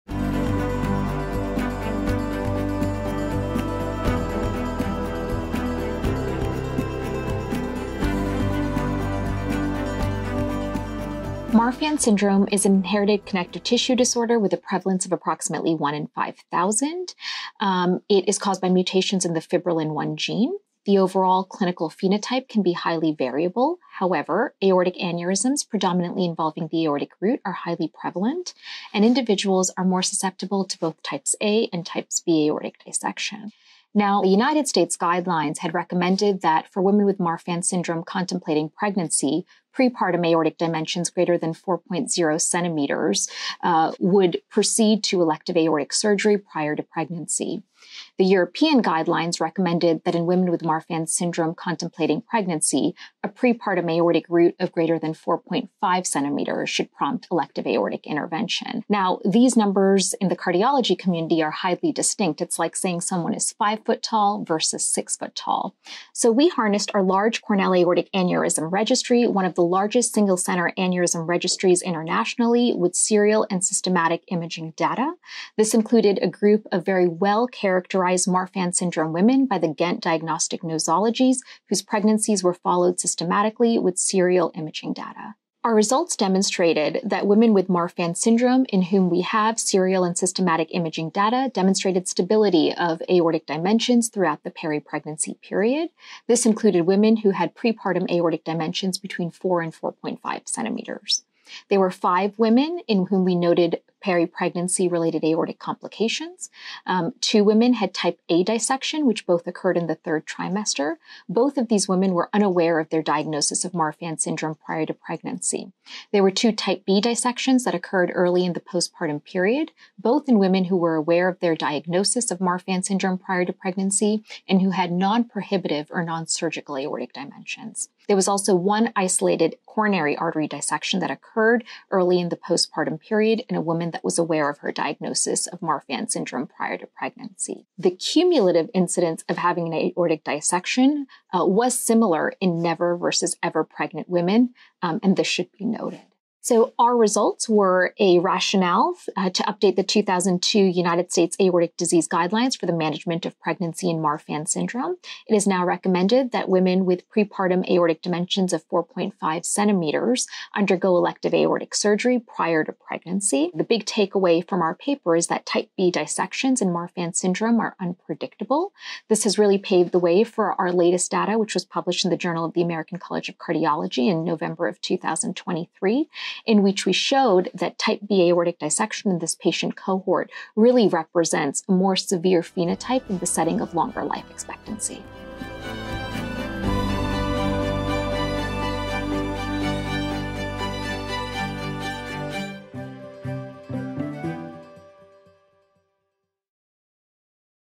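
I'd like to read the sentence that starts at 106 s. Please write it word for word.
Um, two women had type A dissection, which both occurred in the third trimester.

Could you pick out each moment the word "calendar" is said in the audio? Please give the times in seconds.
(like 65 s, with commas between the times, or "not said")
not said.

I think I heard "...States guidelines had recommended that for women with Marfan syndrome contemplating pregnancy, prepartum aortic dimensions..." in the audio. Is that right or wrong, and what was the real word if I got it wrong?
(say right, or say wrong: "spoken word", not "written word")
right.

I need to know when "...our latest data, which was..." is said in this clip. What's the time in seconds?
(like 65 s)
170 s.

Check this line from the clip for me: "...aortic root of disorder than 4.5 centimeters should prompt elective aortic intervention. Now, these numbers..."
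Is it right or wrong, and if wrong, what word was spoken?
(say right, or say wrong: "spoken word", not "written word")
wrong: "greater", not "disorder".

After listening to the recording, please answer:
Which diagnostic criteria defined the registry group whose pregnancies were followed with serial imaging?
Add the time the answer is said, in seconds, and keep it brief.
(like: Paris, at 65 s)
Ghent Diagnostic Nosologies, at 79 s.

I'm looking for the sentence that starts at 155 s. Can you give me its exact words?
It is now recommended that women with prepartum aortic dimensions of 4.5 centimeters undergo elective aortic surgery prior to pregnancy.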